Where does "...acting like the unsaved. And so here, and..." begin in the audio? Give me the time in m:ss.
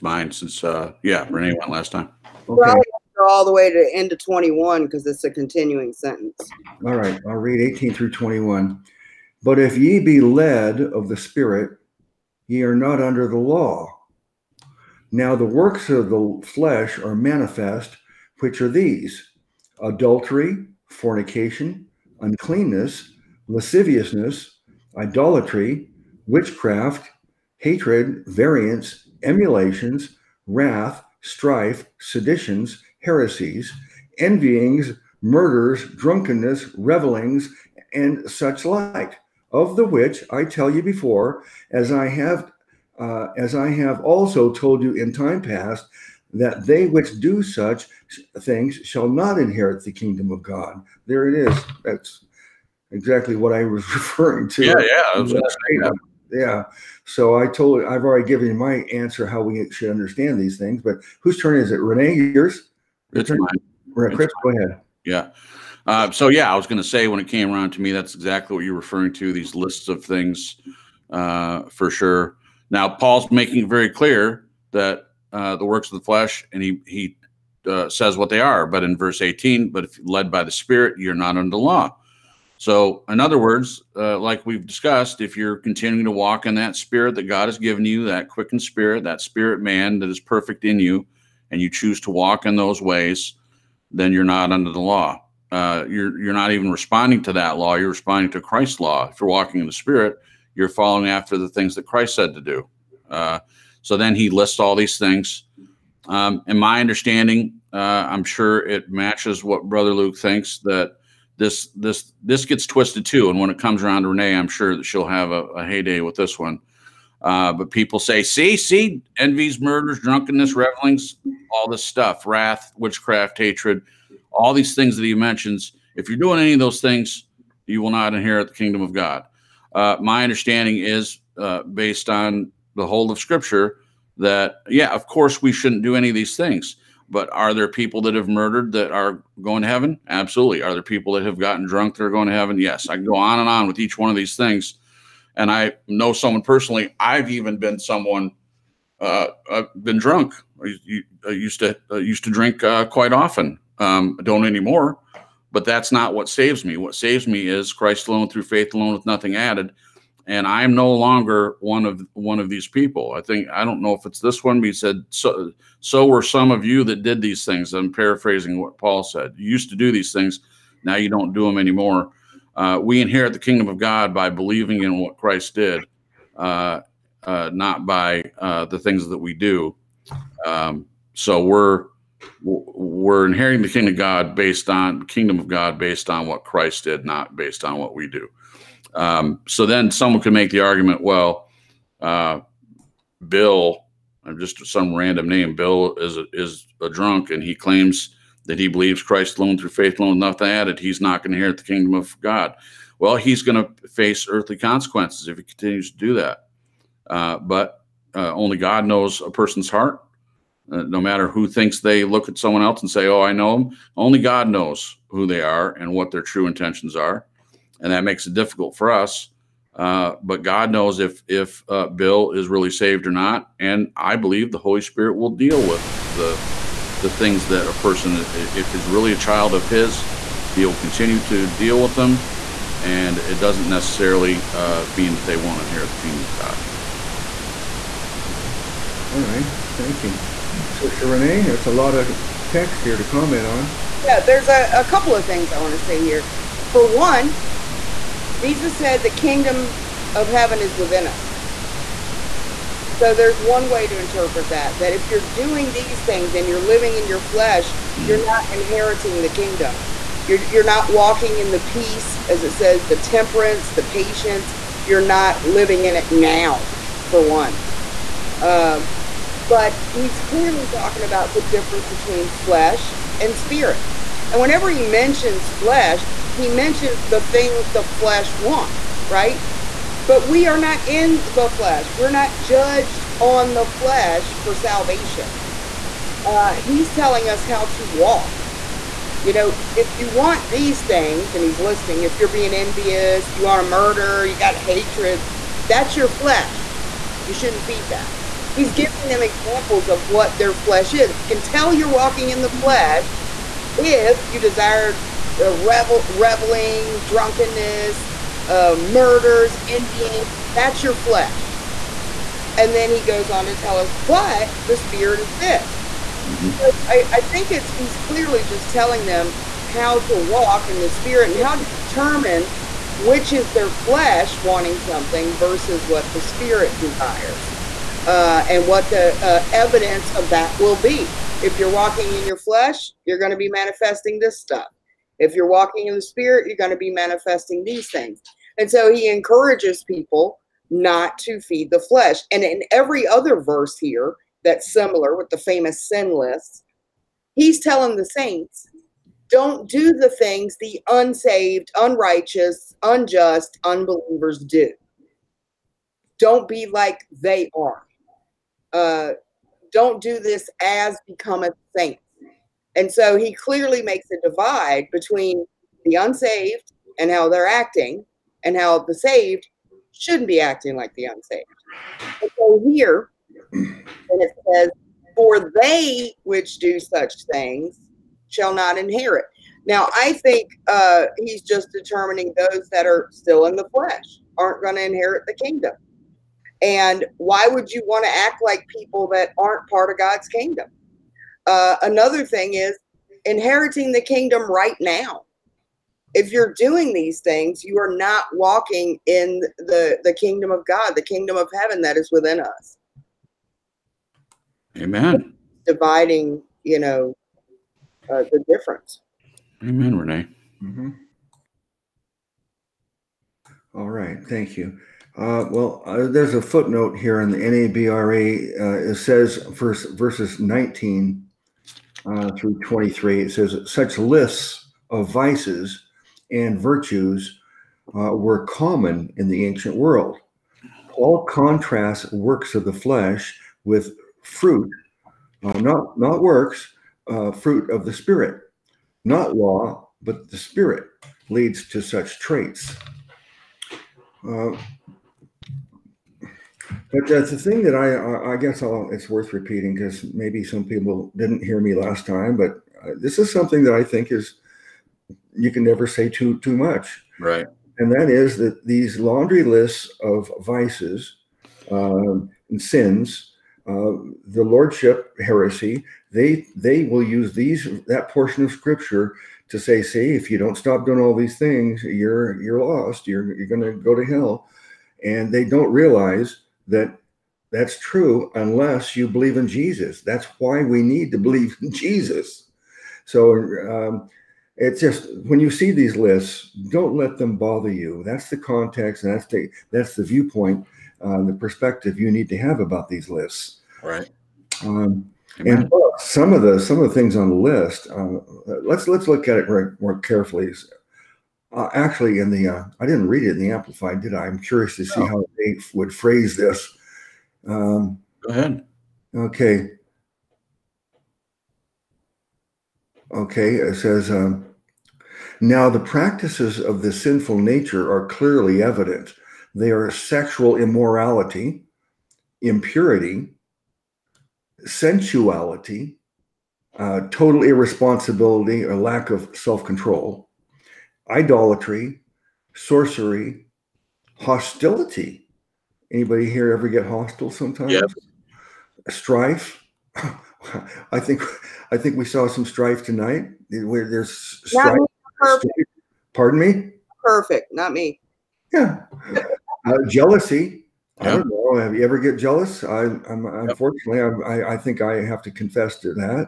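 6:10.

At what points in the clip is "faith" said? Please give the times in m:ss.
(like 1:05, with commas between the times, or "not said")
2:38, 3:19.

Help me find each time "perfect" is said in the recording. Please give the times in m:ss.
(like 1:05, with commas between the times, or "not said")
1:30, 9:07.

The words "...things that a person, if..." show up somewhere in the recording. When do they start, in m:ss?
3:47.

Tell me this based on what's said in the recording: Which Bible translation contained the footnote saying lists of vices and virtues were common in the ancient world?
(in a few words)
NABRE.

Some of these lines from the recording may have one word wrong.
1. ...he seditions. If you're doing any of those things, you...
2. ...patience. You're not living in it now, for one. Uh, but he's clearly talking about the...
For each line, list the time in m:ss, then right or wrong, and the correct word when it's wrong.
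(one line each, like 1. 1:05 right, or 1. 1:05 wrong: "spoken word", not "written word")
1. 2:05 wrong: "mentions", not "seditions"
2. 4:23 right.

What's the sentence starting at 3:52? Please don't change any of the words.
And it doesn't necessarily uh, mean that they won't inherit the kingdom of God.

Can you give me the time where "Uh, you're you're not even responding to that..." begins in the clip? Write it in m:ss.
1:35.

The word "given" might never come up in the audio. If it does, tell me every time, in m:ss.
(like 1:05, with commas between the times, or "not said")
0:58, 1:27.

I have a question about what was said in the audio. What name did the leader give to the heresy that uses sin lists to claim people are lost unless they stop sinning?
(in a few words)
Lordship heresy.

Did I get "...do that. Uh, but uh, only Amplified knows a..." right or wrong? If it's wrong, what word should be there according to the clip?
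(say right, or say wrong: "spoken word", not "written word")
wrong: "God", not "Amplified".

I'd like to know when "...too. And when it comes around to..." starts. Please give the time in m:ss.
1:53.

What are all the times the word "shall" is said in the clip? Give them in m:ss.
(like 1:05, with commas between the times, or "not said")
0:48, 6:18.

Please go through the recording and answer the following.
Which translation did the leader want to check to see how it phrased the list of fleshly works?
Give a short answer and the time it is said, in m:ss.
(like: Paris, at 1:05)
Amplified, at 8:23.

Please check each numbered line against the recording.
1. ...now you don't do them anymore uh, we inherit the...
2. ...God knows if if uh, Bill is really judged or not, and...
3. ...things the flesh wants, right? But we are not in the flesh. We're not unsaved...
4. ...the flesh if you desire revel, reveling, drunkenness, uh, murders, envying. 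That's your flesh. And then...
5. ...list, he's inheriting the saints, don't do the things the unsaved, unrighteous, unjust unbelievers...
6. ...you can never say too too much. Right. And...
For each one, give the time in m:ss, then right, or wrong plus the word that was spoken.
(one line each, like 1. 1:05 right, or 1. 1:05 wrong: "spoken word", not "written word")
1. 2:50 right
2. 3:40 wrong: "saved", not "judged"
3. 4:37 wrong: "judged", not "unsaved"
4. 5:02 right
5. 5:46 wrong: "telling", not "inheriting"
6. 7:35 right.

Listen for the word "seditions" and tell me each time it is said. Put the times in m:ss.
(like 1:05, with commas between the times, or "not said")
0:31.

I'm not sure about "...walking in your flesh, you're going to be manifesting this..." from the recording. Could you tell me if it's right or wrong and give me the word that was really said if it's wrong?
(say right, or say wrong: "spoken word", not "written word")
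right.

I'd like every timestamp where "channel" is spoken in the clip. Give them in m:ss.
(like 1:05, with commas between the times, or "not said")
not said.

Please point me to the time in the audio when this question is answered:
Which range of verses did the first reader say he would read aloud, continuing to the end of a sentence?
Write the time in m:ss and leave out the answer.
0:07.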